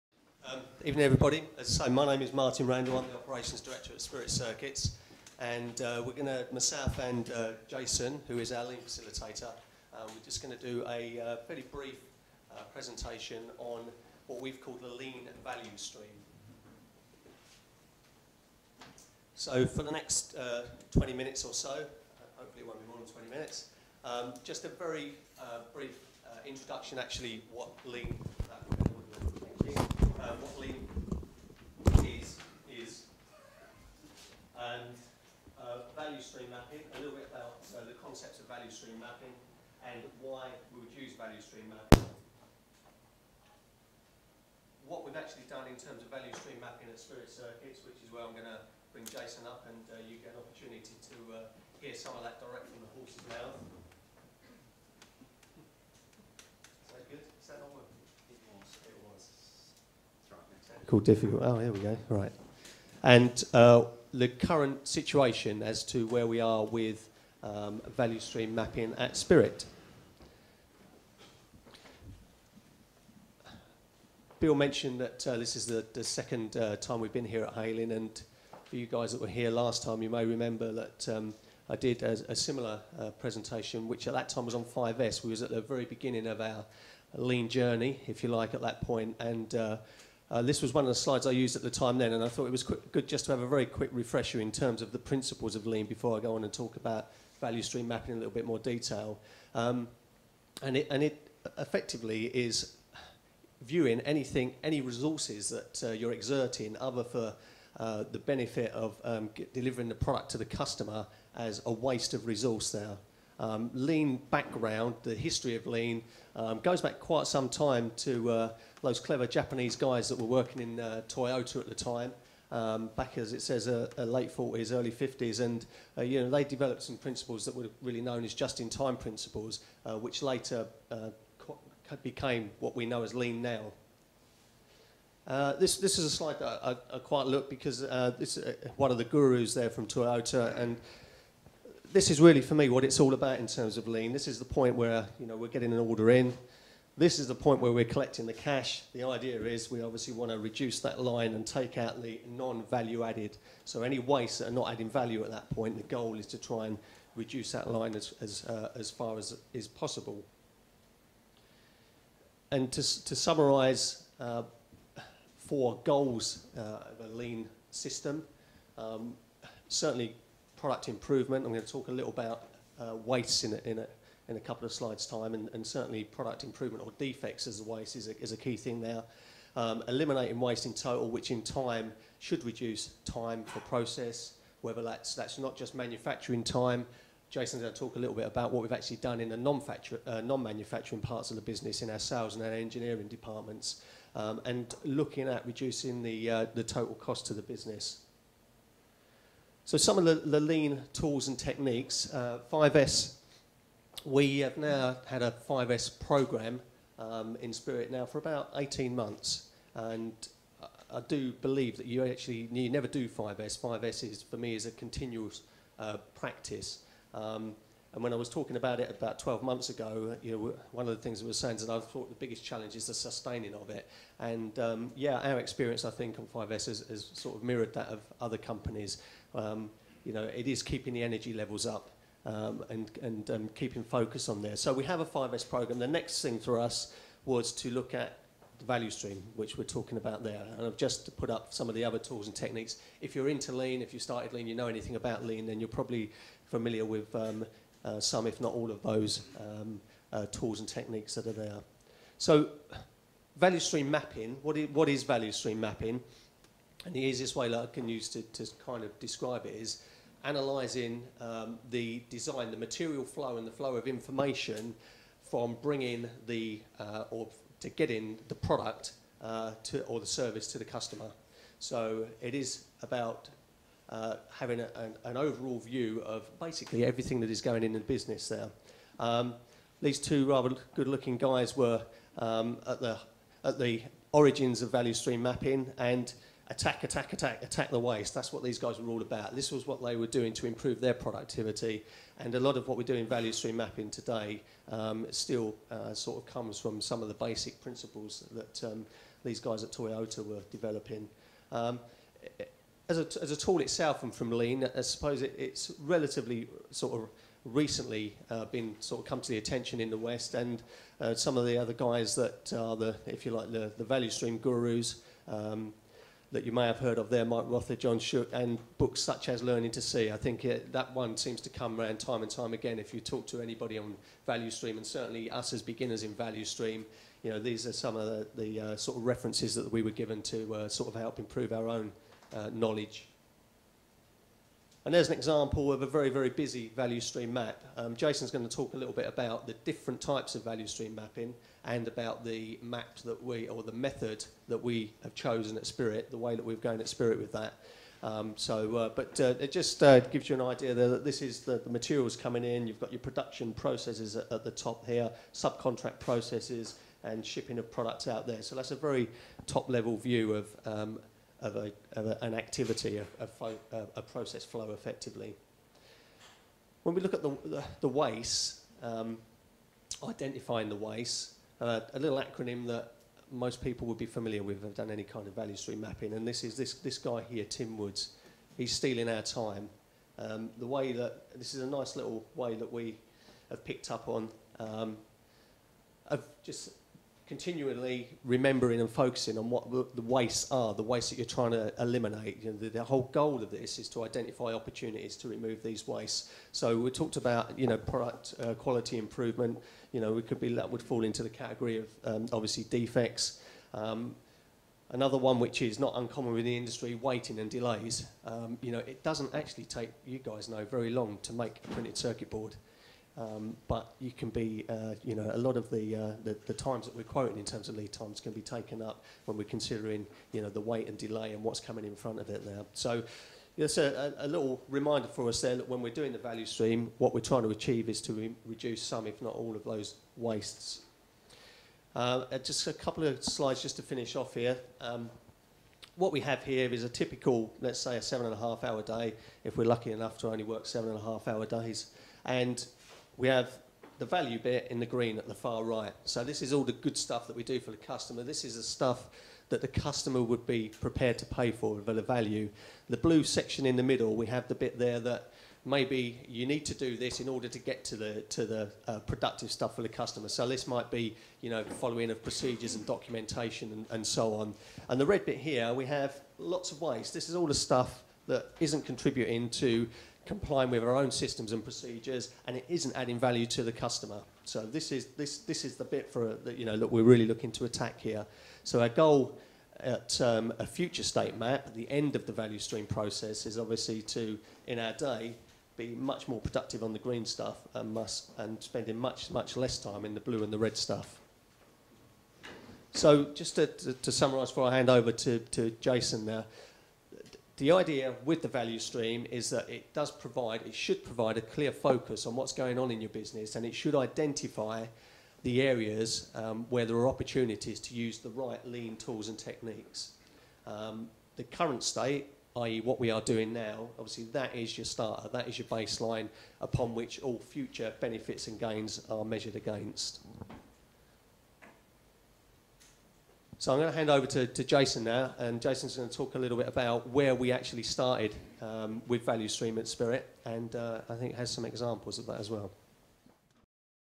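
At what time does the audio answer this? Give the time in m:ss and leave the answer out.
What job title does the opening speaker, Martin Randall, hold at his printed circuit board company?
0:03.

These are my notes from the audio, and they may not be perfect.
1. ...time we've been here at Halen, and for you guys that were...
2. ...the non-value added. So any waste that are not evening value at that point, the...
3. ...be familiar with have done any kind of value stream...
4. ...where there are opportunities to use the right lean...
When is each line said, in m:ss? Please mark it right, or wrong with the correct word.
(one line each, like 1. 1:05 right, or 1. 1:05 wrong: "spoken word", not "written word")
1. 1:16 right
2. 2:32 wrong: "adding", not "evening"
3. 6:13 right
4. 8:26 right.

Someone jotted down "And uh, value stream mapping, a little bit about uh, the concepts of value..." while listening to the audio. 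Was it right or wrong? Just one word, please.
right.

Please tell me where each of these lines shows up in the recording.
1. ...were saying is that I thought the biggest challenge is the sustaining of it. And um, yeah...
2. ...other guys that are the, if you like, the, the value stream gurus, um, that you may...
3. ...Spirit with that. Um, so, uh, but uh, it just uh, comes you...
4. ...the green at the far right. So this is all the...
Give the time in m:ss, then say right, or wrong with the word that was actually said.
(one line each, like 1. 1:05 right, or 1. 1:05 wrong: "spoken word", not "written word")
1. 3:41 right
2. 5:11 right
3. 5:46 wrong: "gives", not "comes"
4. 7:24 right.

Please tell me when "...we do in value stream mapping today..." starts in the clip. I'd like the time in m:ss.
4:52.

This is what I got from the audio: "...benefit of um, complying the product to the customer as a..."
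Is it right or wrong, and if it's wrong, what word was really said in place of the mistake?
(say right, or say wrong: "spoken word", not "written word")
wrong: "delivering", not "complying".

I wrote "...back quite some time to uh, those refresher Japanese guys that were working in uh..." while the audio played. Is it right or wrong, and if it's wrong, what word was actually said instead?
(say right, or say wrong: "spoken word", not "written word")
wrong: "clever", not "refresher".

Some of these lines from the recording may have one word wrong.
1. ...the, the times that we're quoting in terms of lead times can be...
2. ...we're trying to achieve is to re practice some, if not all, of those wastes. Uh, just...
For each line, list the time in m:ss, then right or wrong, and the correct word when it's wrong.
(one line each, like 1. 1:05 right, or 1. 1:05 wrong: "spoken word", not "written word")
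1. 6:56 right
2. 7:07 wrong: "reduce", not "practice".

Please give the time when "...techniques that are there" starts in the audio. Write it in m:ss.
4:10.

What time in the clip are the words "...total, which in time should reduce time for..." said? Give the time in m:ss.
3:00.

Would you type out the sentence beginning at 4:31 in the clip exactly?
So it is about uh, having a, an, an, overall view of basically everything that is going in the business there.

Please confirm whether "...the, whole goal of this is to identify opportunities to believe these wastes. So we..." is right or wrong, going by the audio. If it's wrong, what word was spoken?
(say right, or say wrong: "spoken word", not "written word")
wrong: "remove", not "believe".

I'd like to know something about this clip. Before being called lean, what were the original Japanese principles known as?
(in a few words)
just-in-time principles.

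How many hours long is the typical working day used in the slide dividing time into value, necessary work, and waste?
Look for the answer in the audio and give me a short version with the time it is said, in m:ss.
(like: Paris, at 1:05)
7.5 hours, at 7:18.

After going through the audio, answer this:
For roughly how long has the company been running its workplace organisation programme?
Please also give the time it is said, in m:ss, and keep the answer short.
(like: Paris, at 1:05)
18 months, at 3:28.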